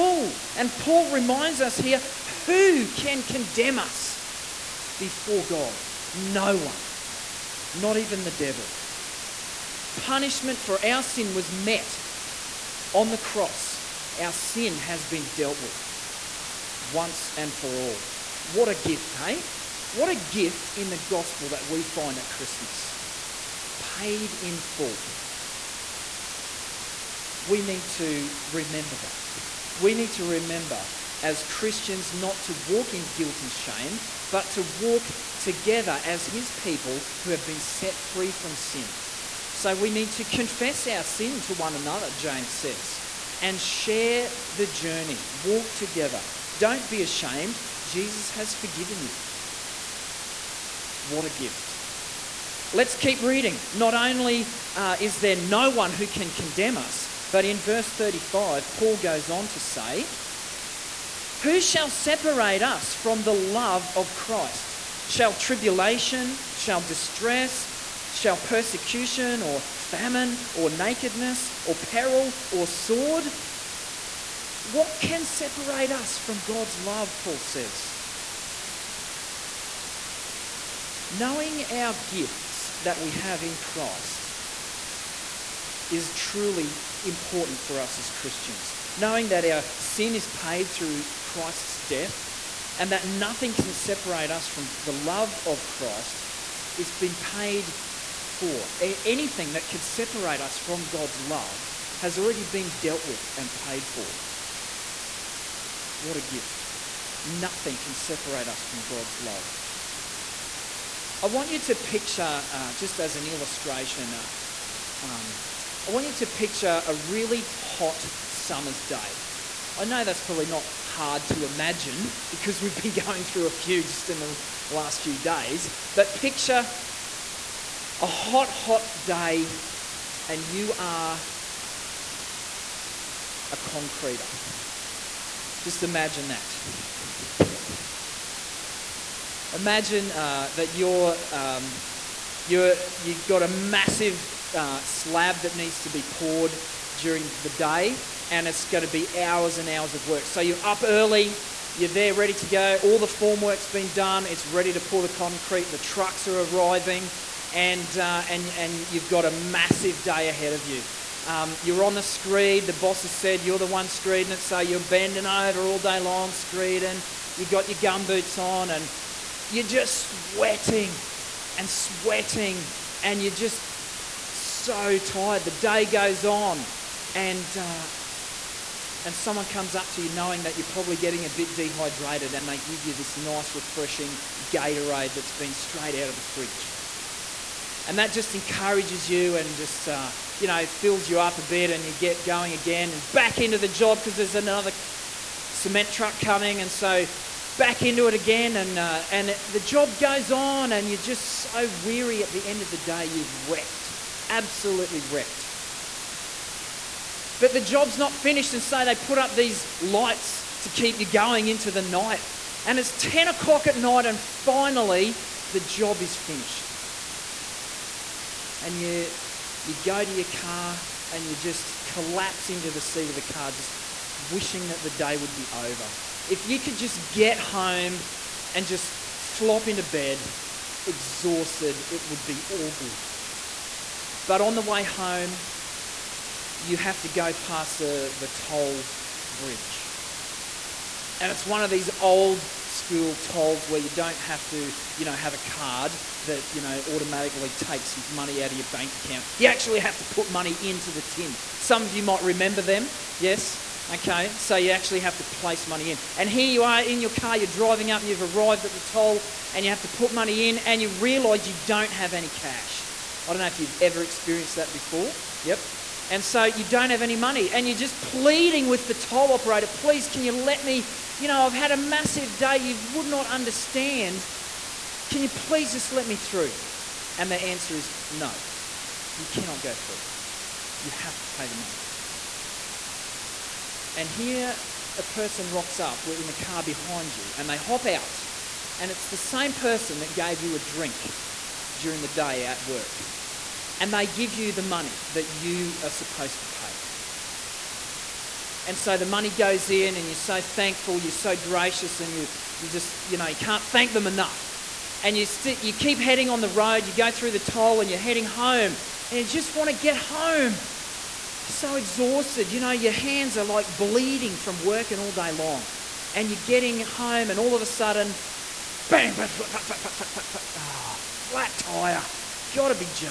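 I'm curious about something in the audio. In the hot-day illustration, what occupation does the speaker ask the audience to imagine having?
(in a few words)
Concreter.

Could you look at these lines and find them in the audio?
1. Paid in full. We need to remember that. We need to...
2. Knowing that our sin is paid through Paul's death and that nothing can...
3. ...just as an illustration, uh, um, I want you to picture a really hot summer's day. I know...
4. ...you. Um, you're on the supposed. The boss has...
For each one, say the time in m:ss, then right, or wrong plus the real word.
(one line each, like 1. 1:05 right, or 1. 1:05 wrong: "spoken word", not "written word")
1. 0:23 right
2. 1:28 wrong: "Christ", not "Paul"
3. 1:52 right
4. 2:40 wrong: "screed", not "supposed".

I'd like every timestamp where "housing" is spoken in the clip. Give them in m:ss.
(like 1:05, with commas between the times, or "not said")
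not said.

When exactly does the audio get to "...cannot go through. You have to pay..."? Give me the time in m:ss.
4:39.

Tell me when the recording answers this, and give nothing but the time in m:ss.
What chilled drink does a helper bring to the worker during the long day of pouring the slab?
3:04.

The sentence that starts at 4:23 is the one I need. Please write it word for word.
I don't know if you've ever experienced that before.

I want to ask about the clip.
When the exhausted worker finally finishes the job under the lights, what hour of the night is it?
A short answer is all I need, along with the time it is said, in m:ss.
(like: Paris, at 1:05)
10 o'clock, at 3:32.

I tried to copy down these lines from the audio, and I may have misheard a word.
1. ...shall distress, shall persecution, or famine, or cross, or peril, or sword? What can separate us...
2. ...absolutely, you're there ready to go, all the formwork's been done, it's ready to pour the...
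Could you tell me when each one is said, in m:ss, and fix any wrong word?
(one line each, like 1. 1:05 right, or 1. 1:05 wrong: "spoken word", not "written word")
1. 1:06 wrong: "nakedness", not "cross"
2. 2:30 wrong: "early", not "absolutely".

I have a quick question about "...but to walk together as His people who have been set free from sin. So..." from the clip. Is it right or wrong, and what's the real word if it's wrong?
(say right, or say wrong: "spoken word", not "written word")
right.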